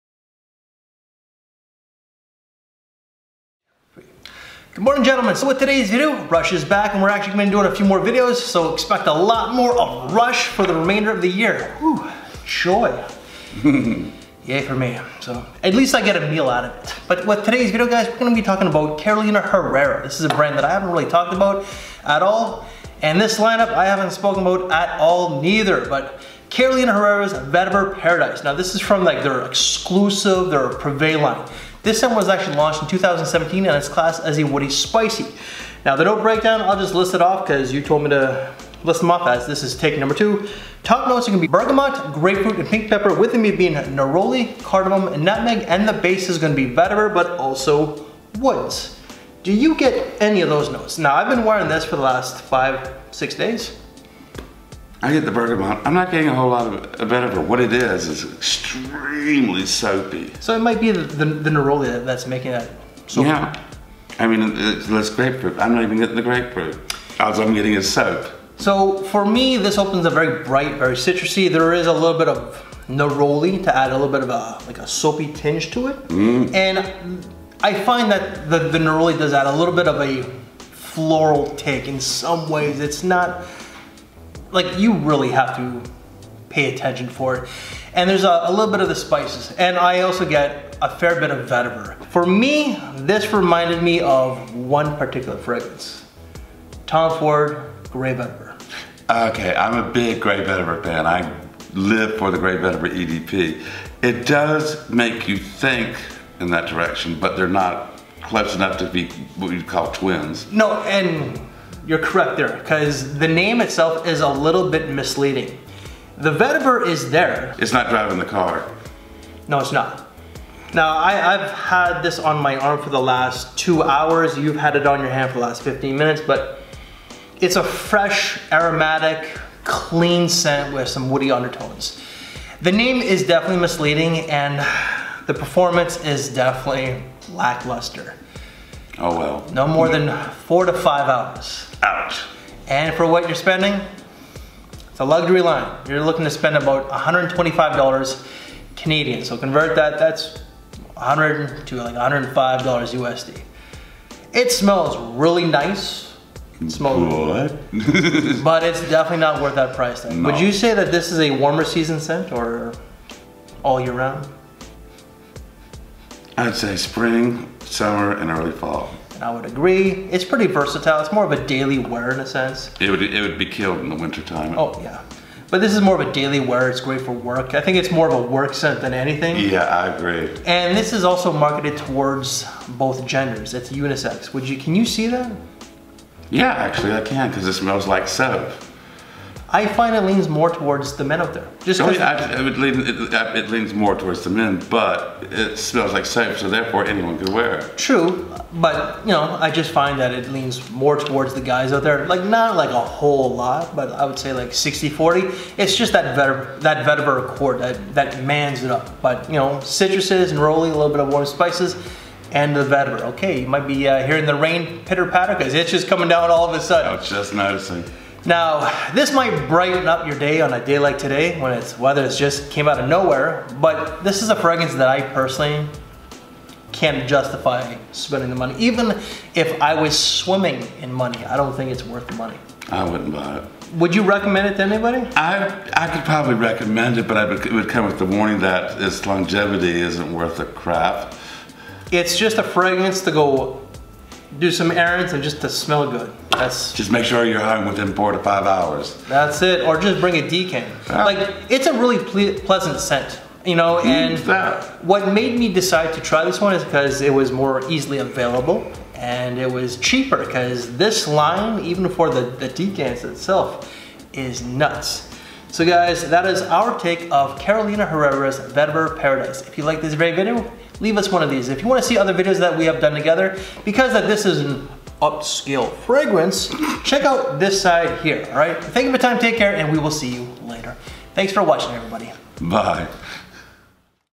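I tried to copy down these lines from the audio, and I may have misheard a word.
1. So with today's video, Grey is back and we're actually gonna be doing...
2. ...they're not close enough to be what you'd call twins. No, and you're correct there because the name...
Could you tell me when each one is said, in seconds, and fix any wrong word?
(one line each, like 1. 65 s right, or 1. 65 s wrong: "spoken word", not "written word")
1. 5 s wrong: "Rush", not "Grey"
2. 107 s right.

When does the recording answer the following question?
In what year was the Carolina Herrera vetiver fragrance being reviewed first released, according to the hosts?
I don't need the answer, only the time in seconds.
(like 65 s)
32 s.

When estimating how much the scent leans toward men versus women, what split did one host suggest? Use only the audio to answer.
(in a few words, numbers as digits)
60-40.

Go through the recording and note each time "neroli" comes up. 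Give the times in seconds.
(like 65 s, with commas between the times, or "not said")
43 s, 61 s, 72 s, 78 s, 210 s.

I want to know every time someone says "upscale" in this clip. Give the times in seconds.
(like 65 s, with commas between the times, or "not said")
275 s.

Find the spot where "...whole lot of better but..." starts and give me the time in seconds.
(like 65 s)
56 s.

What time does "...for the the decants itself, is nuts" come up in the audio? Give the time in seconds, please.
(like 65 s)
261 s.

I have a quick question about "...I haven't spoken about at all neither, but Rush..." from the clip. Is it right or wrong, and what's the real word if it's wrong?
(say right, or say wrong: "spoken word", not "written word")
wrong: "Carolina", not "Rush".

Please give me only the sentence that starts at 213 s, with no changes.
Okay, you might be uh, hearing the rain pitter patter because it's just coming down all of a sudden.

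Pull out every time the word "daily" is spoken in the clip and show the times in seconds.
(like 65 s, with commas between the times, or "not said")
171 s, 176 s.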